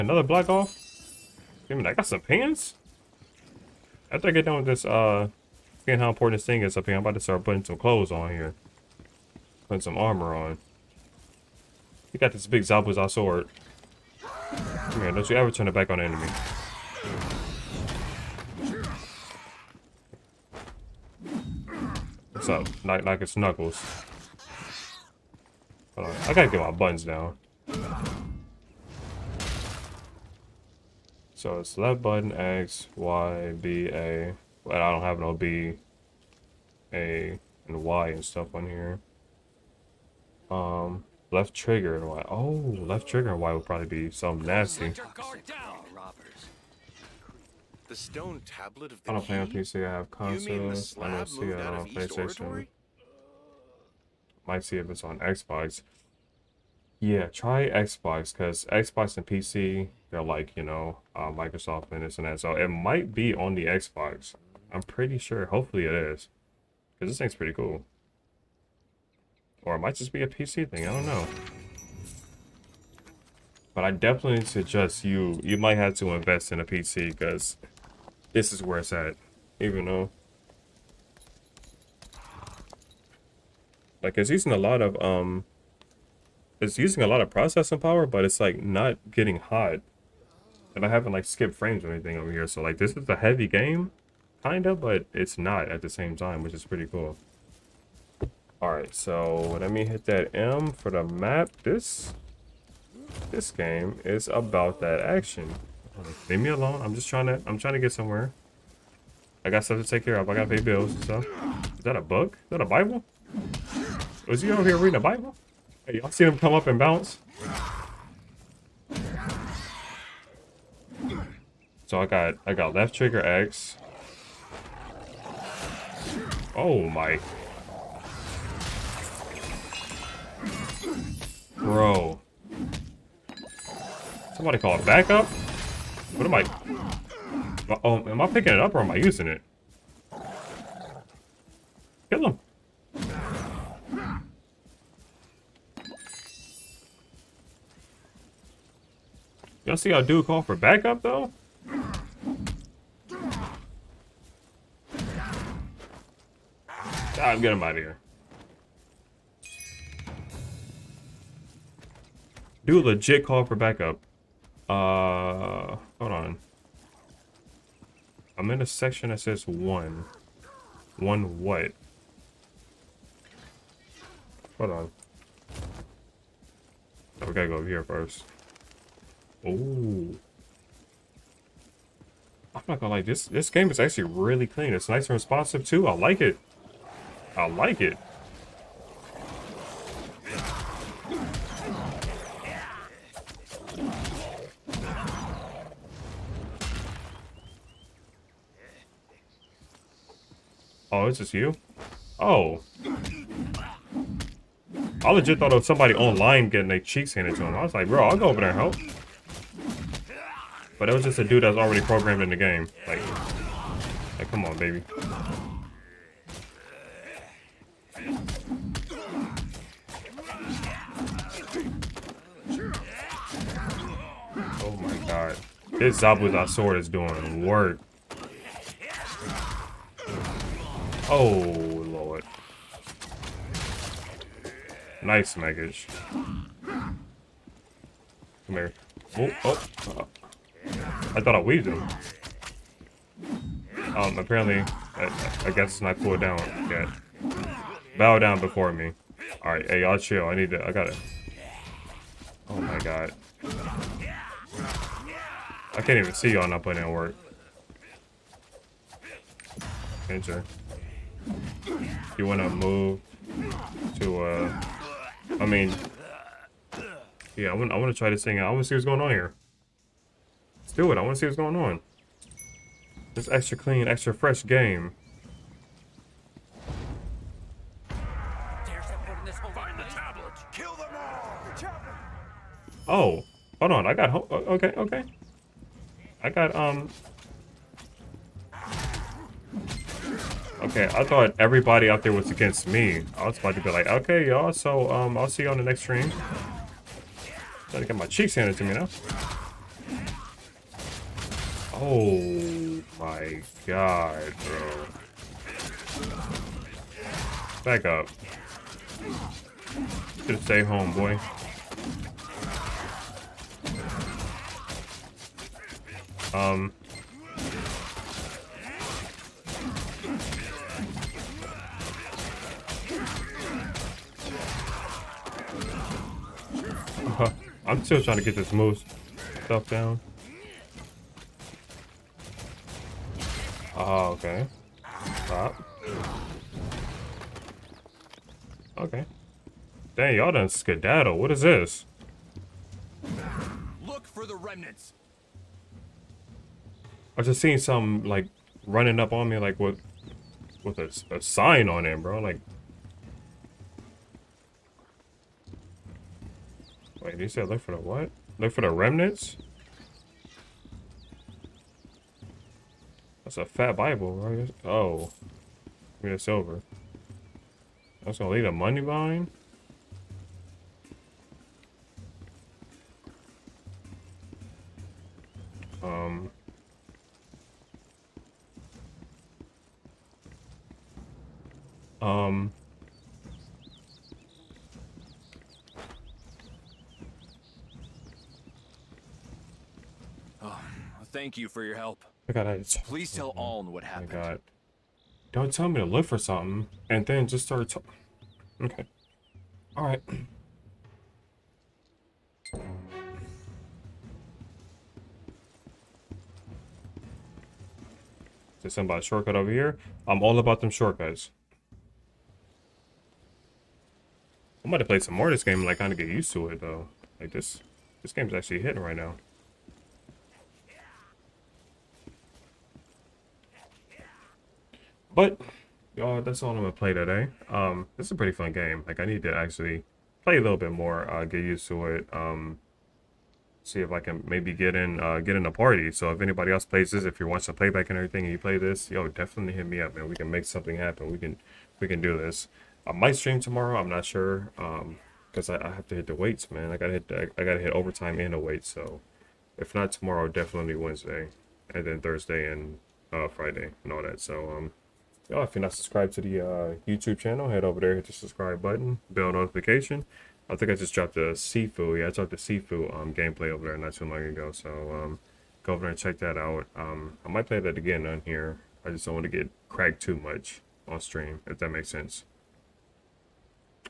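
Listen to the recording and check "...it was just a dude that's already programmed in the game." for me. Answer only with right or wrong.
right.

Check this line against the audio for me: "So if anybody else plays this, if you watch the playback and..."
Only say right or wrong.
right.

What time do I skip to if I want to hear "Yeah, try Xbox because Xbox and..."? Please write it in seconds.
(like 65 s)
56 s.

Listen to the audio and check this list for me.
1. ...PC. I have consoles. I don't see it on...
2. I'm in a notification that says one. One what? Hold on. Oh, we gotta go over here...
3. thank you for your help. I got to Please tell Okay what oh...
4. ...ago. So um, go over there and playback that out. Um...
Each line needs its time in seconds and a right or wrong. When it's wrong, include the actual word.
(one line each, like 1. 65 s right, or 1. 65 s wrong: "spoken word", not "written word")
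1. 49 s right
2. 168 s wrong: "section", not "notification"
3. 391 s wrong: "Aln", not "Okay"
4. 464 s wrong: "check", not "playback".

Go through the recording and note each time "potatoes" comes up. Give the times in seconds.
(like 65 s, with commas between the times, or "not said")
not said.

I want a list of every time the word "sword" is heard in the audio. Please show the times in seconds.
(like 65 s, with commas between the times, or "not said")
13 s, 226 s.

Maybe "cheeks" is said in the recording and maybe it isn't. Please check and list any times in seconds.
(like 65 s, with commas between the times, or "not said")
206 s, 298 s.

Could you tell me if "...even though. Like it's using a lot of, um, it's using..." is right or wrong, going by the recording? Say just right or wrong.
right.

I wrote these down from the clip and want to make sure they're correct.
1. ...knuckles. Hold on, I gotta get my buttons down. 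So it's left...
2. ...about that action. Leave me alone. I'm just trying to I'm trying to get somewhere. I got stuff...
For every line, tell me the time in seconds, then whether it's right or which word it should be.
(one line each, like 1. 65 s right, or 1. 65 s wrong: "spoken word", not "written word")
1. 23 s right
2. 104 s right.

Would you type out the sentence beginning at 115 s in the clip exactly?
Hey, y'all seen him come up and bounce?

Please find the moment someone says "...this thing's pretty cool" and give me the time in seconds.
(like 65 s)
67 s.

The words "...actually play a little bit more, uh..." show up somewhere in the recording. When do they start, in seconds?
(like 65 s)
429 s.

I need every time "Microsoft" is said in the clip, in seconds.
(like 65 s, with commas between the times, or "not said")
61 s.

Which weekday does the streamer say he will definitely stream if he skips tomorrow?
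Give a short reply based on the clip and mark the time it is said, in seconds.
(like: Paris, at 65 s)
Wednesday, at 450 s.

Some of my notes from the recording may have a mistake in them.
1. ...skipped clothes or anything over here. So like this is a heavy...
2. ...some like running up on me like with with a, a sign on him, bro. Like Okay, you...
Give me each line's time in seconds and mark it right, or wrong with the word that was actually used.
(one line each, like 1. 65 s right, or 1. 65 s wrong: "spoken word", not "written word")
1. 91 s wrong: "frames", not "clothes"
2. 347 s wrong: "Wait", not "Okay".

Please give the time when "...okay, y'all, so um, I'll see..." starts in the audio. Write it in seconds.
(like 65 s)
293 s.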